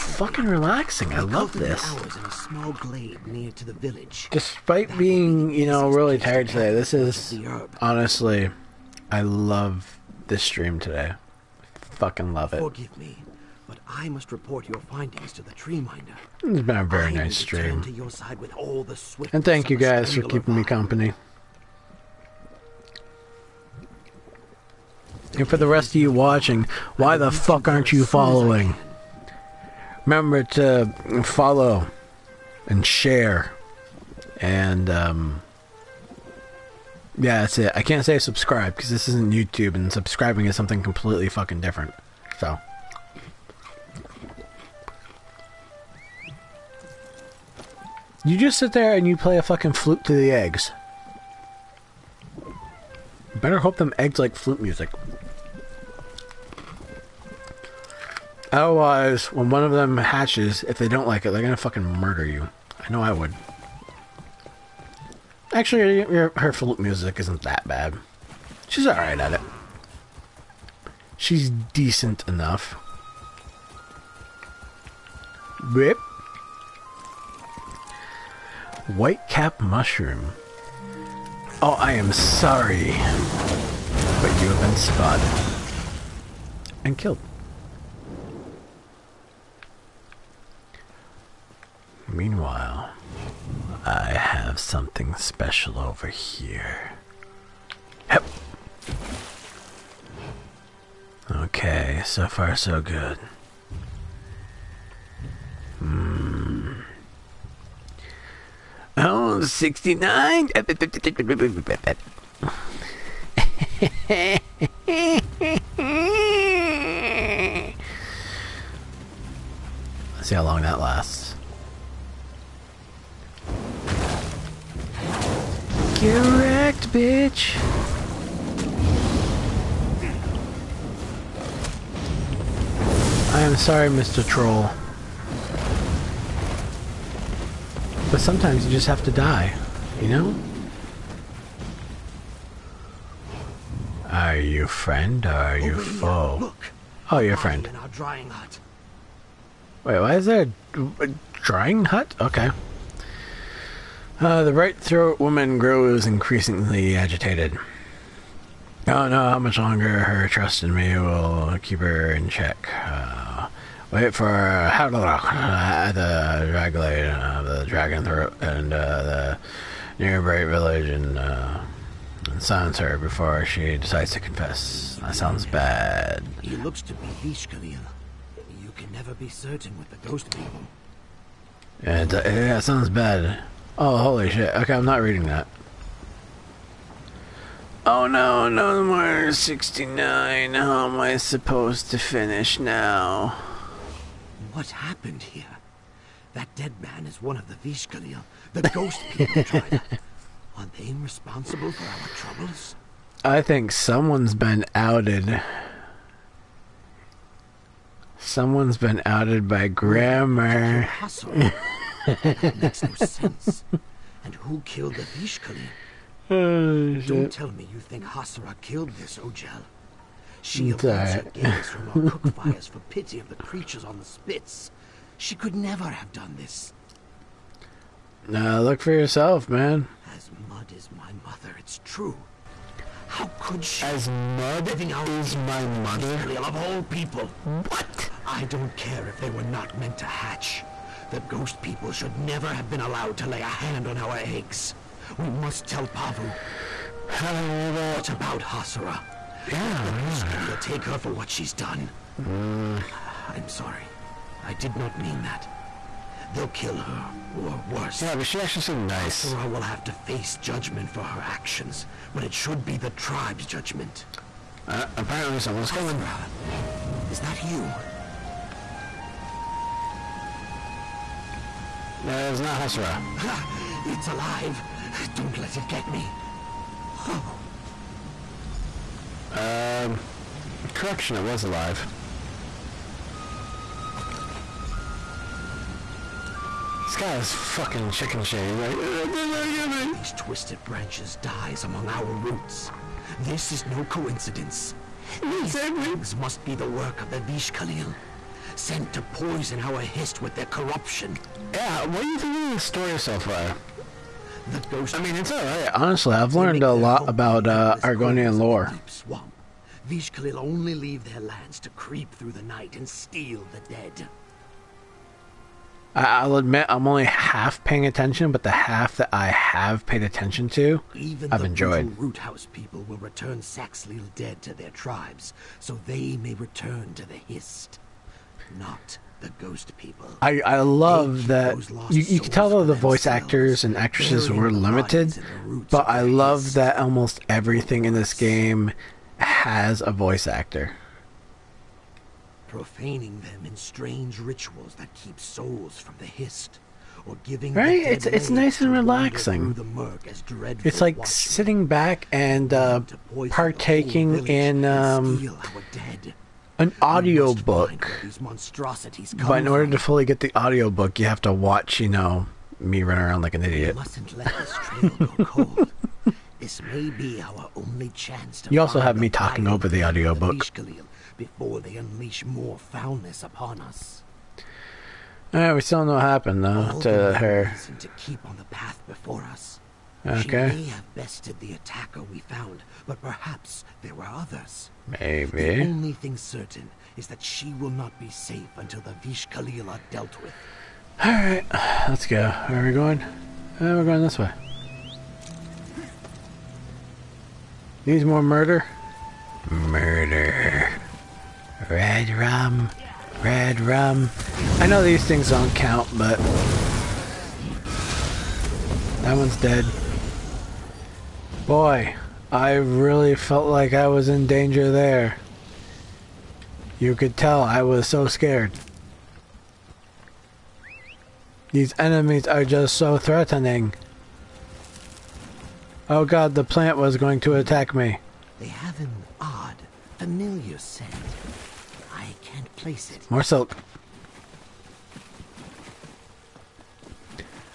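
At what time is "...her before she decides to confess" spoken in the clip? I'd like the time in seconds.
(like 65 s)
172 s.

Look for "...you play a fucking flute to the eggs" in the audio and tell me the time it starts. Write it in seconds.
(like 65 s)
49 s.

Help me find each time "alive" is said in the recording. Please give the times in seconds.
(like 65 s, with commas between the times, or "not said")
274 s, 281 s.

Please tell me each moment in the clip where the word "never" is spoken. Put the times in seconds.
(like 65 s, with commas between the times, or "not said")
178 s, 225 s, 242 s.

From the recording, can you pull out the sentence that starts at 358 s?
But in order to fully get the audio book, you have to watch, you know, me run around like an idiot.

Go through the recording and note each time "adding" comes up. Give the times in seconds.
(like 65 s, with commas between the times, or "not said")
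not said.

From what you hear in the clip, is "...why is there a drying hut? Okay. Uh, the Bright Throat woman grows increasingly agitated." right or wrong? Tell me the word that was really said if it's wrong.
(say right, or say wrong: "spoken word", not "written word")
right.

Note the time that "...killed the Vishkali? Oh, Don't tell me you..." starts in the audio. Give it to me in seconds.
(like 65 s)
214 s.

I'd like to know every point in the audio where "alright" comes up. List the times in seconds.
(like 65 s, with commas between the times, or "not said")
68 s, 391 s.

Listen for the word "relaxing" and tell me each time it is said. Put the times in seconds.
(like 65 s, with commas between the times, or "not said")
0 s, 348 s.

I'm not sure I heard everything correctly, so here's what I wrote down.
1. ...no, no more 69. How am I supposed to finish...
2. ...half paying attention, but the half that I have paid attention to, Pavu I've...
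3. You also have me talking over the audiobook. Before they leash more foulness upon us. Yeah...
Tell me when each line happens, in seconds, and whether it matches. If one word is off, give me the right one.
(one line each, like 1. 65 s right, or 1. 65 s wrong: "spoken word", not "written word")
1. 188 s right
2. 317 s wrong: "Even", not "Pavu"
3. 368 s wrong: "unleash", not "leash".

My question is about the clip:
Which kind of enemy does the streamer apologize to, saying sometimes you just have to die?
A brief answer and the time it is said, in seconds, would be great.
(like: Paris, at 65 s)
Troll, at 133 s.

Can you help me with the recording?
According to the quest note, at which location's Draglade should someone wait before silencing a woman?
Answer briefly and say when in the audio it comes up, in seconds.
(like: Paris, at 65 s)
Dragon Throat, at 167 s.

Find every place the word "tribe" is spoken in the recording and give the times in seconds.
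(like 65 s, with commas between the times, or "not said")
199 s, 262 s, 324 s.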